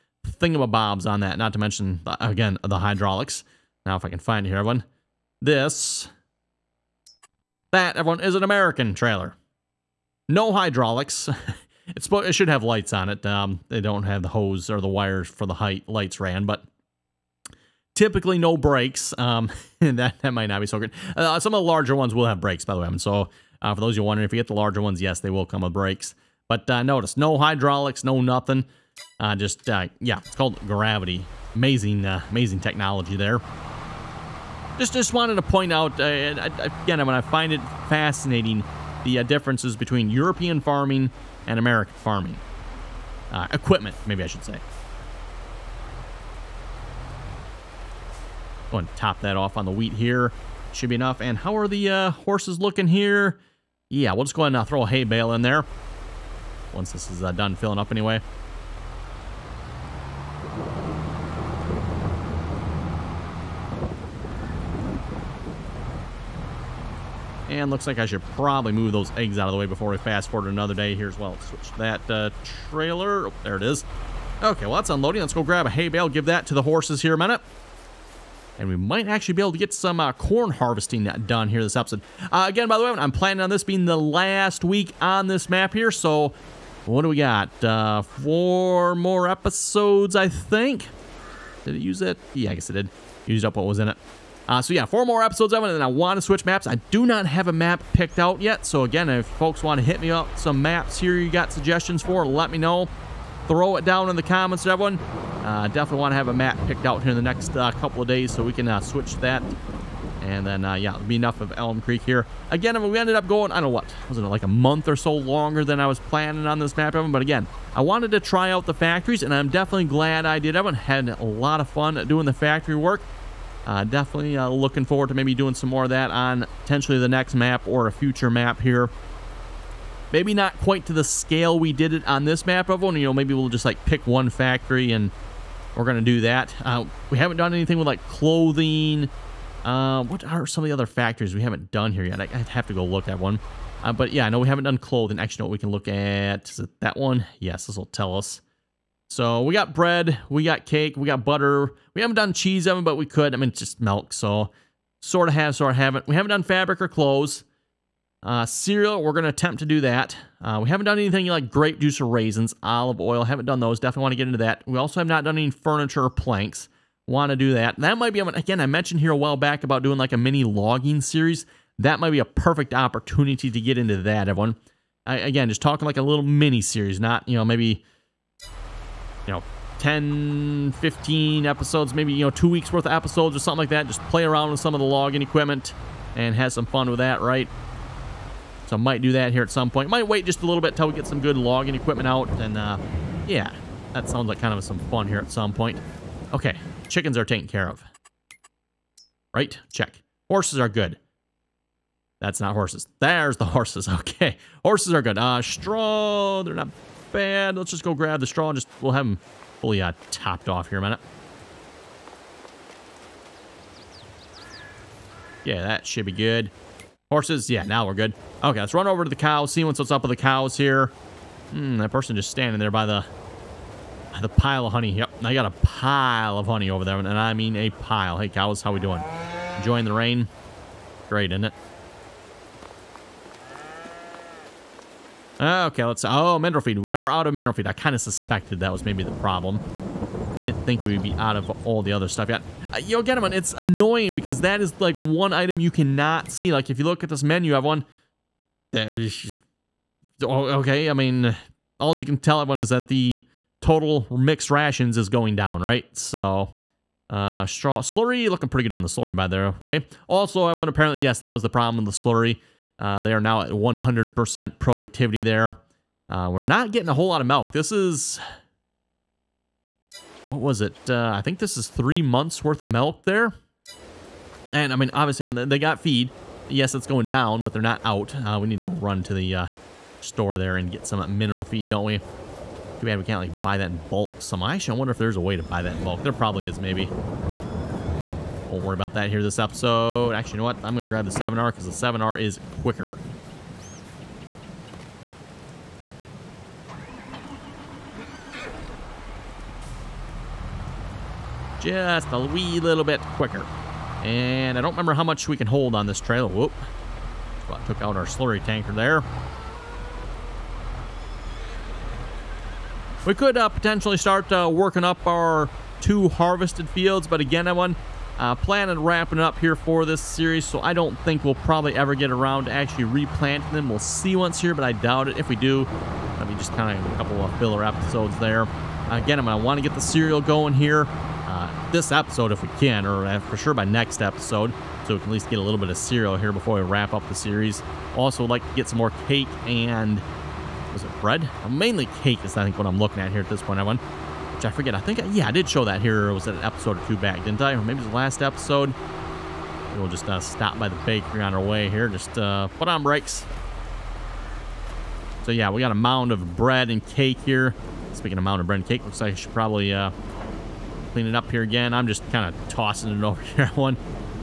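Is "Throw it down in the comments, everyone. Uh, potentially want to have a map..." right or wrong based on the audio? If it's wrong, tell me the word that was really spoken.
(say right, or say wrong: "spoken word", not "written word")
wrong: "definitely", not "potentially".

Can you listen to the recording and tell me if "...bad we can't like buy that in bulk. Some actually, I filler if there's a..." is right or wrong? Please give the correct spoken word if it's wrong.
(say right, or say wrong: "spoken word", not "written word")
wrong: "wonder", not "filler".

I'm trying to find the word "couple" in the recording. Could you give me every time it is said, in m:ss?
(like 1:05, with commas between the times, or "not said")
1:47, 5:26.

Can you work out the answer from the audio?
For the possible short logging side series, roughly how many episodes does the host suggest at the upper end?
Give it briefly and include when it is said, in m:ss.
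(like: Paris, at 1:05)
15, at 3:00.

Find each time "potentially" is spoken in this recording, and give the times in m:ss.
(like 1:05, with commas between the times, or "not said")
2:06, 5:13.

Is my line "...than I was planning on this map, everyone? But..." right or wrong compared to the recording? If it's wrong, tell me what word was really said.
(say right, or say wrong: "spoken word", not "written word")
right.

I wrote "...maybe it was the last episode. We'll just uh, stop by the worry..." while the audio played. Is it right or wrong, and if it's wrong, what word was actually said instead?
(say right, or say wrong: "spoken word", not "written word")
wrong: "bakery", not "worry".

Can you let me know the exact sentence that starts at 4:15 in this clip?
So, uh, straw slurry looking pretty good on the slurry by the way.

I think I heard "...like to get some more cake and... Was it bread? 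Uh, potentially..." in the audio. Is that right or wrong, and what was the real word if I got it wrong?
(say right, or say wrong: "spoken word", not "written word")
wrong: "mainly", not "potentially".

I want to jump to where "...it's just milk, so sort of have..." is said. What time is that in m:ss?
2:33.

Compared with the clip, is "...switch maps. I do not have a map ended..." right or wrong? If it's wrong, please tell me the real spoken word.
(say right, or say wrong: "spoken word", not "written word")
wrong: "picked", not "ended".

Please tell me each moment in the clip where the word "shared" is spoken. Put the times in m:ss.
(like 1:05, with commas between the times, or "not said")
not said.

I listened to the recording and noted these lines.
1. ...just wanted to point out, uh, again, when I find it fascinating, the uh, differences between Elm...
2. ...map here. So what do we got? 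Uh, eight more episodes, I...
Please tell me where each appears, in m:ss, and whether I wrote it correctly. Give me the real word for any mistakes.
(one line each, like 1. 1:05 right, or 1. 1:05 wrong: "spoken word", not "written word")
1. 0:34 wrong: "European", not "Elm"
2. 1:25 wrong: "four", not "eight".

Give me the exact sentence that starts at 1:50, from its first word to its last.
And then, uh, yeah, it'll be enough of Elm Creek here.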